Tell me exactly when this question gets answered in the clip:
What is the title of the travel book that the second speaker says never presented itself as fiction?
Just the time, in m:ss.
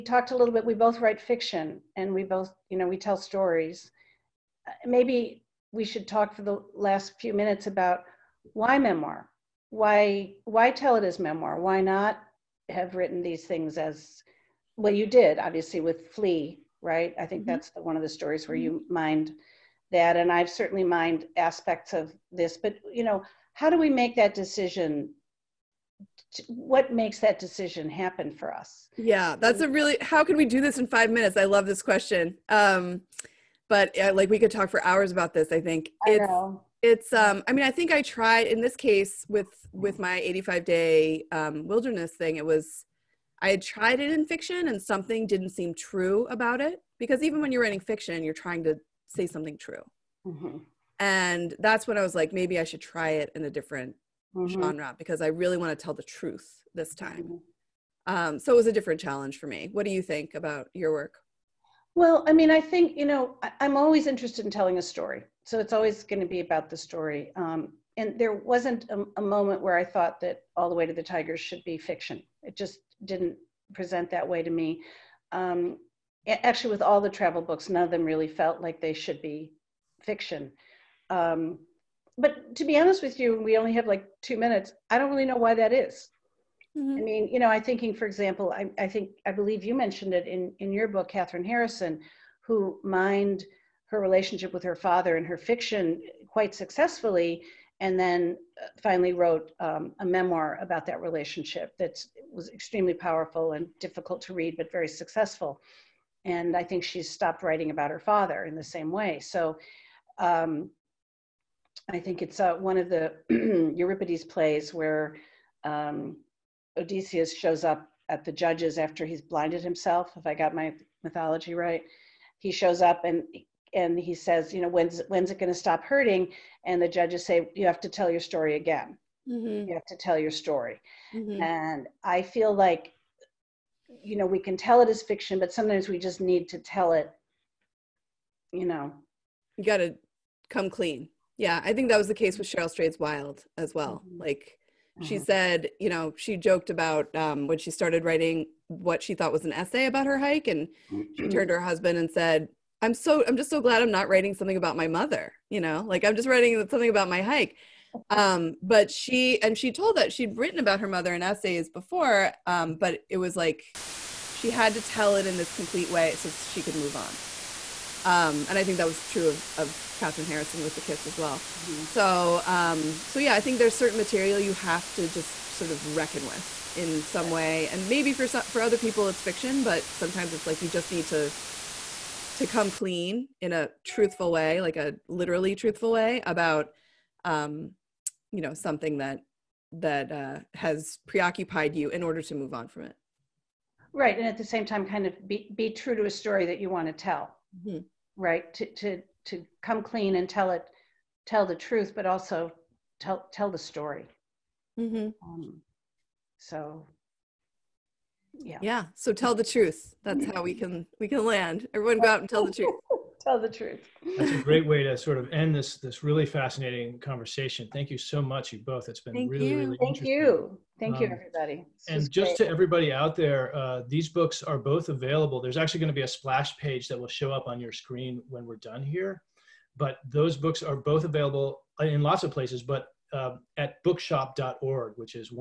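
1:10.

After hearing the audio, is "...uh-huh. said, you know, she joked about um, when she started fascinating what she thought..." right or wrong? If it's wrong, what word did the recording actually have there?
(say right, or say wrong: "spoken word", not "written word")
wrong: "writing", not "fascinating".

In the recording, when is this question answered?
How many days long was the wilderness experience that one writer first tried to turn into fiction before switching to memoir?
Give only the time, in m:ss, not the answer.
0:40.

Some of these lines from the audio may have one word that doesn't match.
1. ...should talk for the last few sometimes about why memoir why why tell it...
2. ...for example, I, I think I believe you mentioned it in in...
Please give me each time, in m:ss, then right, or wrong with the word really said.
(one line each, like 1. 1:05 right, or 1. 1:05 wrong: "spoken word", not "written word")
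1. 0:05 wrong: "minutes", not "sometimes"
2. 1:27 right.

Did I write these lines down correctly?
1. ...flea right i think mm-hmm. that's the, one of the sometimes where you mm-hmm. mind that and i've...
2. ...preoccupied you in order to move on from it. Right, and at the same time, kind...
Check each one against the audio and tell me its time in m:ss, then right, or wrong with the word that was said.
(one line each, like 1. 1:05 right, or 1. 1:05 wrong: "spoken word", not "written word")
1. 0:16 wrong: "stories", not "sometimes"
2. 3:11 right.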